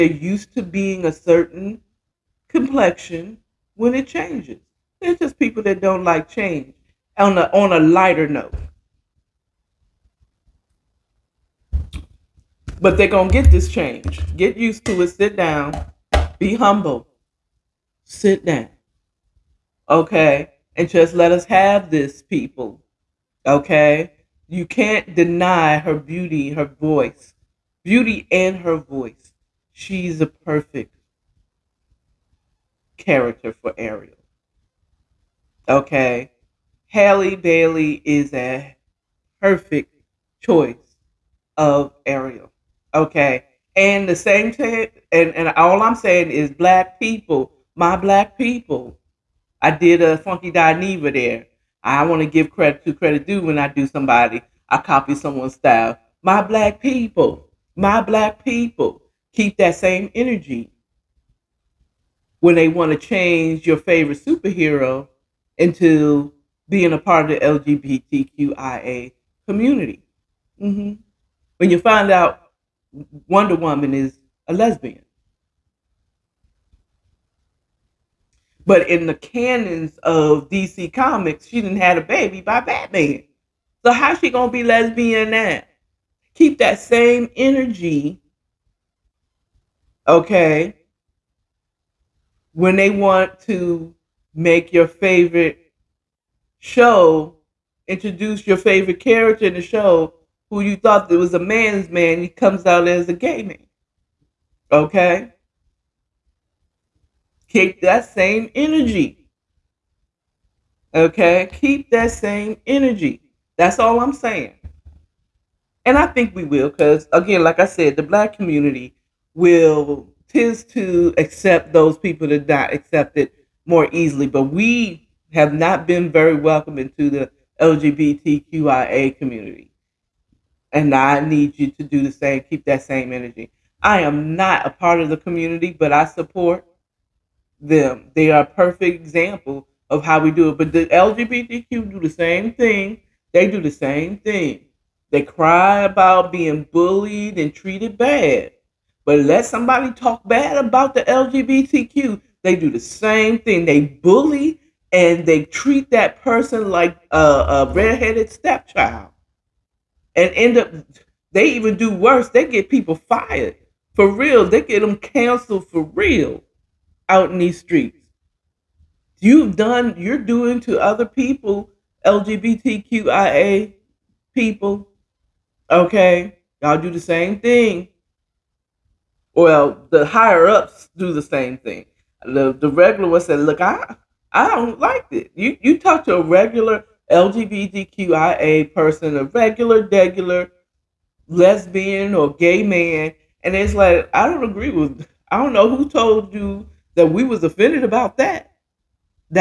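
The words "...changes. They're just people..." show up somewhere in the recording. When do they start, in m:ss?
0:04.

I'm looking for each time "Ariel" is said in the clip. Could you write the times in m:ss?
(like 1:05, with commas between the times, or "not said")
0:33, 0:42.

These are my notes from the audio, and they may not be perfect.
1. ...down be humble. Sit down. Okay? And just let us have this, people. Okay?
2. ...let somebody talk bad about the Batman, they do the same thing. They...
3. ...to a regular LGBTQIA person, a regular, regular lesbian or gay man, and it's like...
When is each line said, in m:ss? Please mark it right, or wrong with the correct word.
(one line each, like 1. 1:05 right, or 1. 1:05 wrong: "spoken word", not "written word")
1. 0:15 right
2. 2:29 wrong: "LGBTQ", not "Batman"
3. 3:06 right.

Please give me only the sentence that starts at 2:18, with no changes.
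They are a perfect example of how we do it.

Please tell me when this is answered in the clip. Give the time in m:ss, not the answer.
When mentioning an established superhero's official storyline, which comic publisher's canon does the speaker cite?
1:20.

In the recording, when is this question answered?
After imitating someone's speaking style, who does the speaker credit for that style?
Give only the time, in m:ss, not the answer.
0:50.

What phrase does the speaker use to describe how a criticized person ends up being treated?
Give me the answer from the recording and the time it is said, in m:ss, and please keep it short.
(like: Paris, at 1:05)
a redheaded stepchild, at 2:37.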